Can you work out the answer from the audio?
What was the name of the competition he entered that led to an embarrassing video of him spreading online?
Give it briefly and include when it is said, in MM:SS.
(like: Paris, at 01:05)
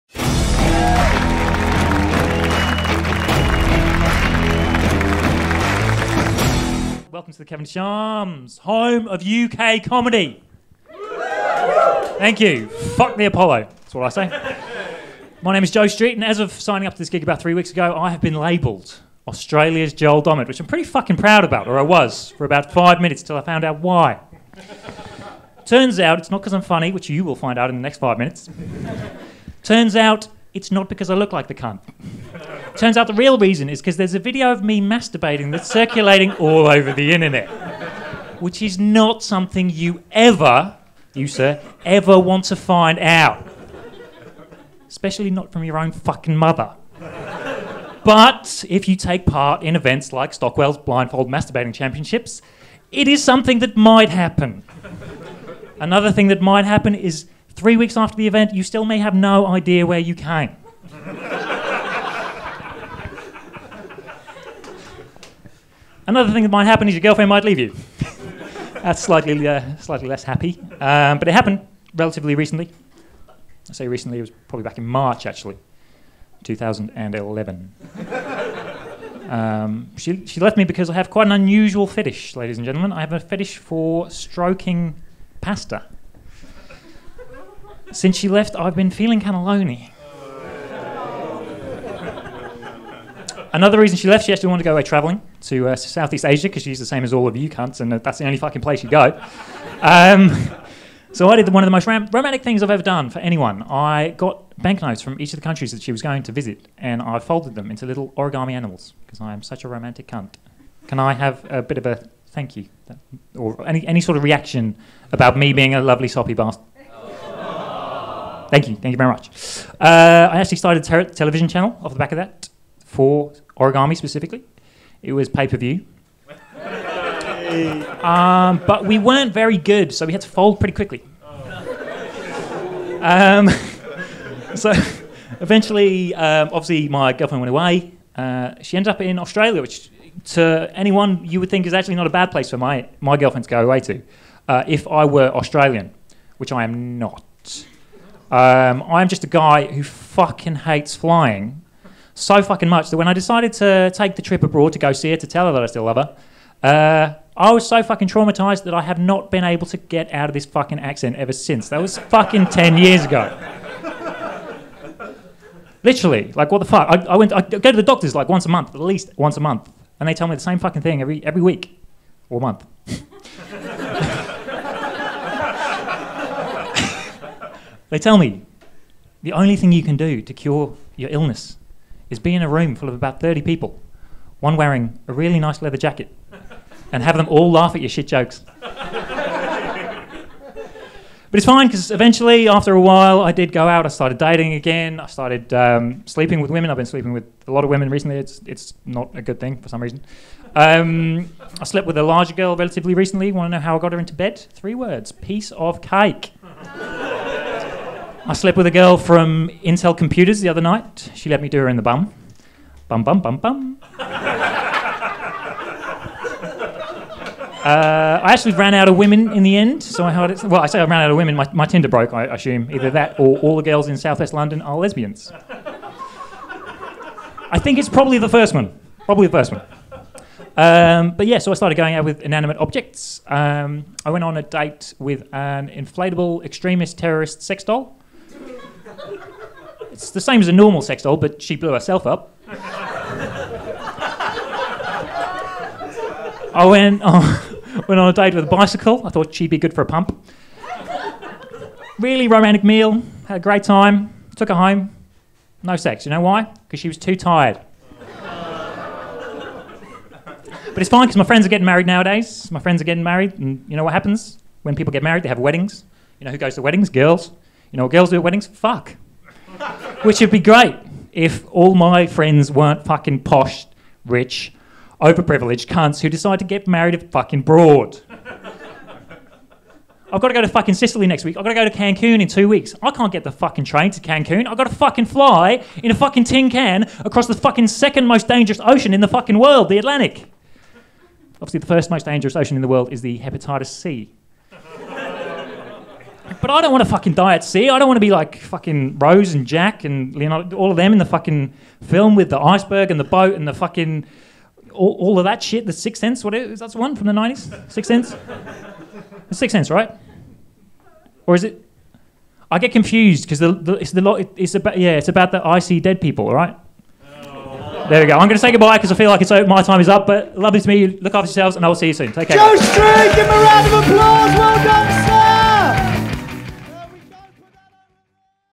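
Stockwell's Blindfold Masturbating Championships, at 00:50.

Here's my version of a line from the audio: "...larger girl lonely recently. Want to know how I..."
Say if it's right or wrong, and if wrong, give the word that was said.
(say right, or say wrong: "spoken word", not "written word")
wrong: "relatively", not "lonely".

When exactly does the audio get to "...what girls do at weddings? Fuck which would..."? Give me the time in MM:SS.
04:27.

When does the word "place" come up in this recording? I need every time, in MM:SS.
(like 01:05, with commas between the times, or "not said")
01:38, 02:22.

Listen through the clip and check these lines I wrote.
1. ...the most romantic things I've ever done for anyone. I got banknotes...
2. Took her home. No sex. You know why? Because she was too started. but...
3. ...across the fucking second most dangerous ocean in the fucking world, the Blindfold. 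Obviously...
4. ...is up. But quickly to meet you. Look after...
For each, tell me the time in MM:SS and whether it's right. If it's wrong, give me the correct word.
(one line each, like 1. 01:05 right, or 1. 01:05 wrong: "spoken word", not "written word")
1. 01:41 right
2. 04:14 wrong: "tired", not "started"
3. 04:47 wrong: "Atlantic", not "Blindfold"
4. 05:19 wrong: "lovely", not "quickly".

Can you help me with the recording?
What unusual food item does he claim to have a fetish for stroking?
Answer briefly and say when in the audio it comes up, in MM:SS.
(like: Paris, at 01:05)
Pasta, at 01:25.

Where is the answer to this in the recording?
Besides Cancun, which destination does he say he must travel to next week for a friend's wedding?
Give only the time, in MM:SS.
04:40.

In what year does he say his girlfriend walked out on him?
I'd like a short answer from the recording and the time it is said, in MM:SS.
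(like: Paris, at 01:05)
2011, at 01:16.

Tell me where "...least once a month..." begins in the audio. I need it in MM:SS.
02:48.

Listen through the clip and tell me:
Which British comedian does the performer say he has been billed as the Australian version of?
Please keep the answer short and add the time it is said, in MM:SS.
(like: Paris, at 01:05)
Joel Dommett, at 00:19.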